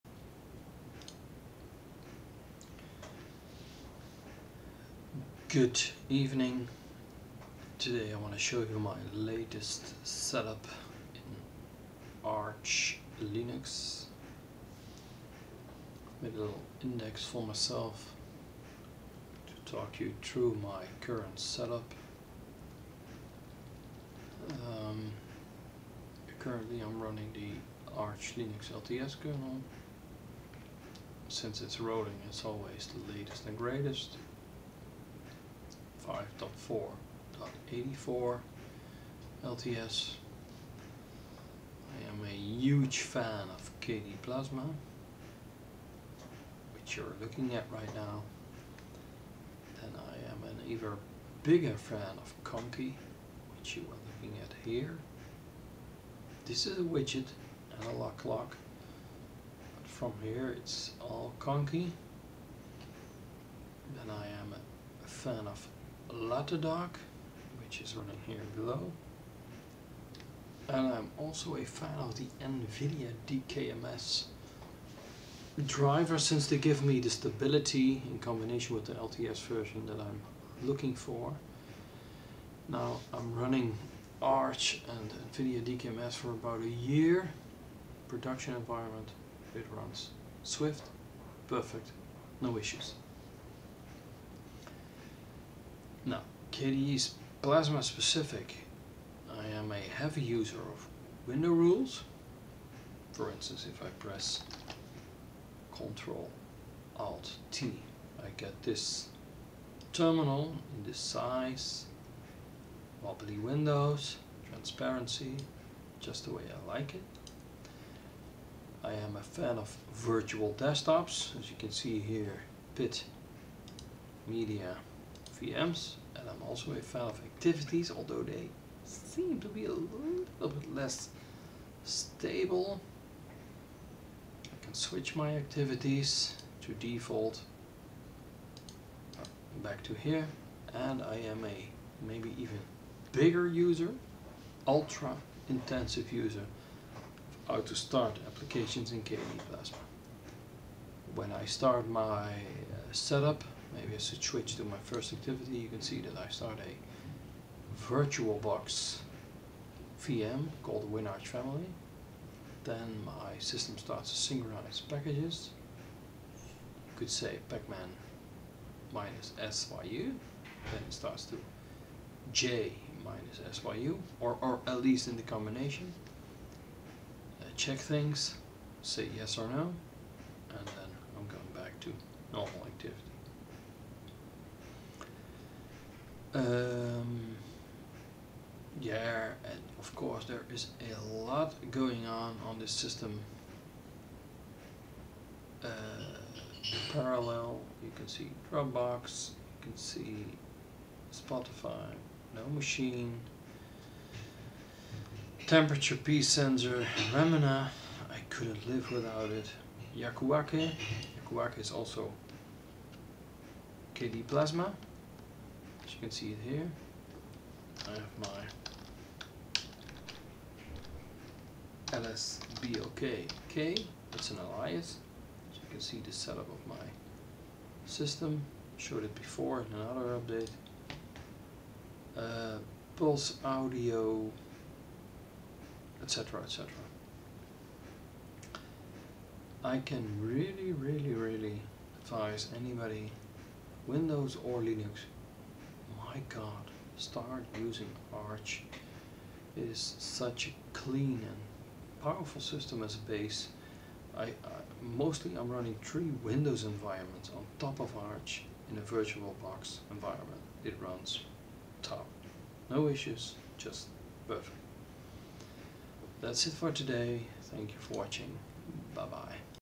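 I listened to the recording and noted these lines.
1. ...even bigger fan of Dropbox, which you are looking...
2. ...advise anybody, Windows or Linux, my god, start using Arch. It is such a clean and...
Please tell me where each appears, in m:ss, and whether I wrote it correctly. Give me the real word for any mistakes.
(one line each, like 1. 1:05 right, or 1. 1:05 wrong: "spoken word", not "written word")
1. 0:50 wrong: "Conky", not "Dropbox"
2. 4:02 right.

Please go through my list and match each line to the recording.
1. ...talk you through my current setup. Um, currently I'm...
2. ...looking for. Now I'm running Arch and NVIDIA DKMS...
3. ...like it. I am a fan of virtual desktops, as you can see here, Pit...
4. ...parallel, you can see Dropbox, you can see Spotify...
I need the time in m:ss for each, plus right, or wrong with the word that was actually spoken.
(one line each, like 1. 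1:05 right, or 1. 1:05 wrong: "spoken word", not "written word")
1. 0:19 right
2. 1:20 right
3. 1:56 right
4. 3:16 right.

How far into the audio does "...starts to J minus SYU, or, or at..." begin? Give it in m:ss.
2:50.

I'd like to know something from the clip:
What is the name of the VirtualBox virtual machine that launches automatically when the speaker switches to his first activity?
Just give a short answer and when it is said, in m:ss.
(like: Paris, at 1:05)
WinArch Family, at 2:40.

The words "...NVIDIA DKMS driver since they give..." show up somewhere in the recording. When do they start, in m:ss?
1:12.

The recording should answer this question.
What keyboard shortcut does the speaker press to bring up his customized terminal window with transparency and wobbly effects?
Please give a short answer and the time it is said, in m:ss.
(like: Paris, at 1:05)
Ctrl Alt T, at 1:45.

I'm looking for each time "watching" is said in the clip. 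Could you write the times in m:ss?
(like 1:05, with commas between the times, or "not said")
4:27.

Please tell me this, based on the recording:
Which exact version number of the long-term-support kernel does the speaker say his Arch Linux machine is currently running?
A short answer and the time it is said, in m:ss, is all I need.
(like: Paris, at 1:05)
5.4.84, at 0:36.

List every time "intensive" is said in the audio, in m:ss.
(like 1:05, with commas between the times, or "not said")
2:25.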